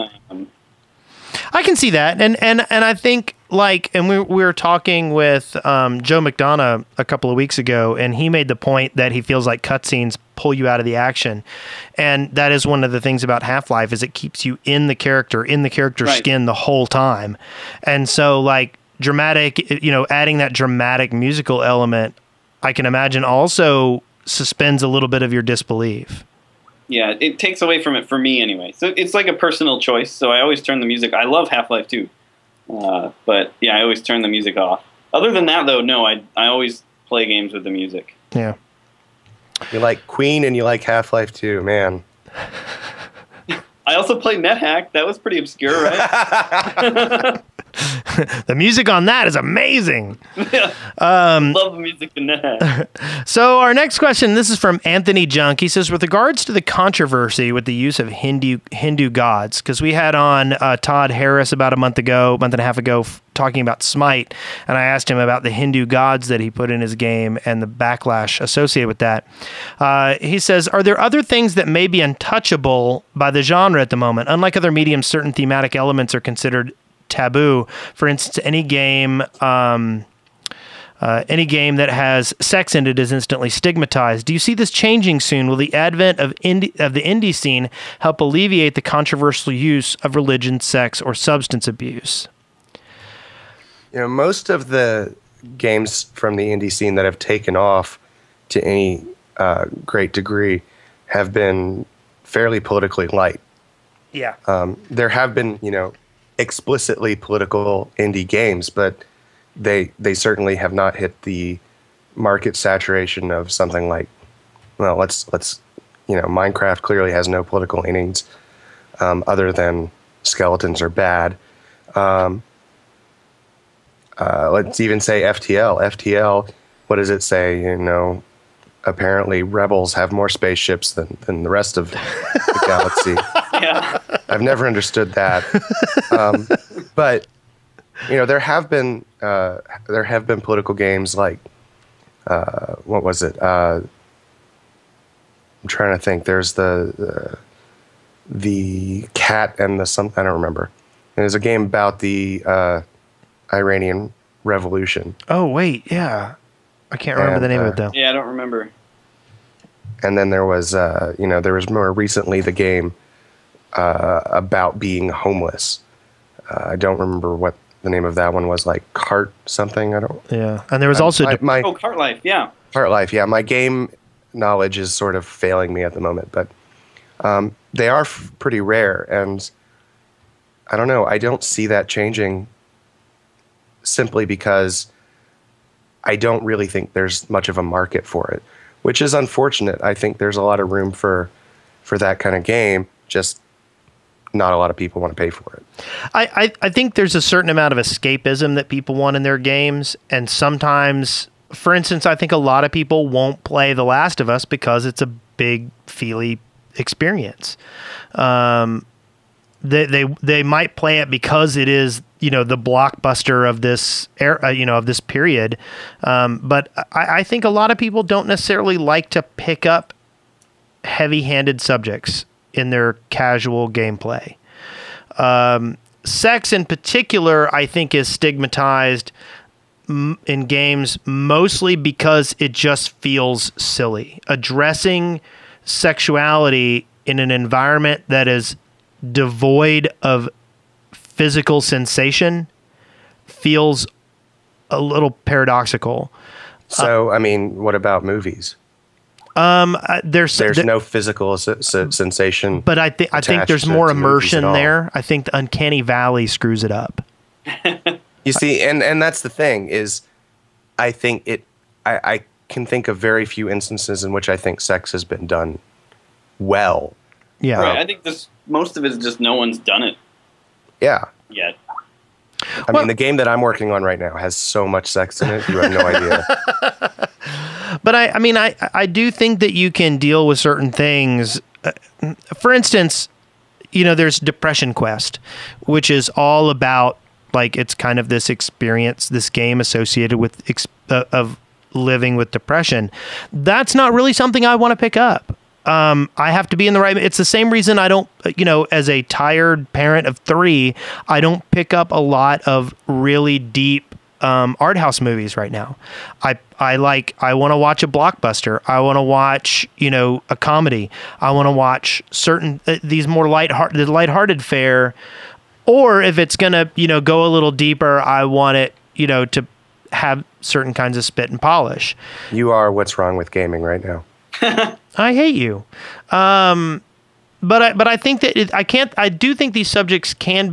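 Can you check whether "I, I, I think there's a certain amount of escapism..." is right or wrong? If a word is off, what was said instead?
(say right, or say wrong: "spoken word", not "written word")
right.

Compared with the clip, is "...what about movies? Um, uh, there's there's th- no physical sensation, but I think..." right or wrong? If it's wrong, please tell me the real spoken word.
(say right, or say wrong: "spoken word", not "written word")
right.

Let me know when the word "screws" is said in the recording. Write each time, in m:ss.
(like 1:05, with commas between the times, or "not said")
4:16.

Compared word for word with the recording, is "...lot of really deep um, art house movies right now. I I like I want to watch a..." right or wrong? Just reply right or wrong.
right.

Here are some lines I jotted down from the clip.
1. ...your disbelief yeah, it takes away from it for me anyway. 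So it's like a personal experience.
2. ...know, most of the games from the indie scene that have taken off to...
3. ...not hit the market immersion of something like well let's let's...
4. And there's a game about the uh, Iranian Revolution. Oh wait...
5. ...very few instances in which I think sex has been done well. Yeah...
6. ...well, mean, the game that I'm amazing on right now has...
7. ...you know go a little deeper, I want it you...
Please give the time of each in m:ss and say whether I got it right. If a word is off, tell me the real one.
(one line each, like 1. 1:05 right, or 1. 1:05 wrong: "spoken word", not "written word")
1. 0:25 wrong: "choice", not "experience"
2. 1:33 right
3. 1:50 wrong: "saturation", not "immersion"
4. 2:31 right
5. 4:22 right
6. 4:32 wrong: "working", not "amazing"
7. 5:16 right.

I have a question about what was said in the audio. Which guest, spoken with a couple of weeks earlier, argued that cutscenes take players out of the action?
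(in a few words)
Joe McDonough.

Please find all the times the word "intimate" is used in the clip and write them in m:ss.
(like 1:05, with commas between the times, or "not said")
not said.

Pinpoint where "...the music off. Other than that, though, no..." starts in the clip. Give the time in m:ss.
0:34.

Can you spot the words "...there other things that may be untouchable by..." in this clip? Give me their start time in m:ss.
1:10.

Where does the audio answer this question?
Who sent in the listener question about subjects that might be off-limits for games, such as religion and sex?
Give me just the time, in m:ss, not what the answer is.
0:54.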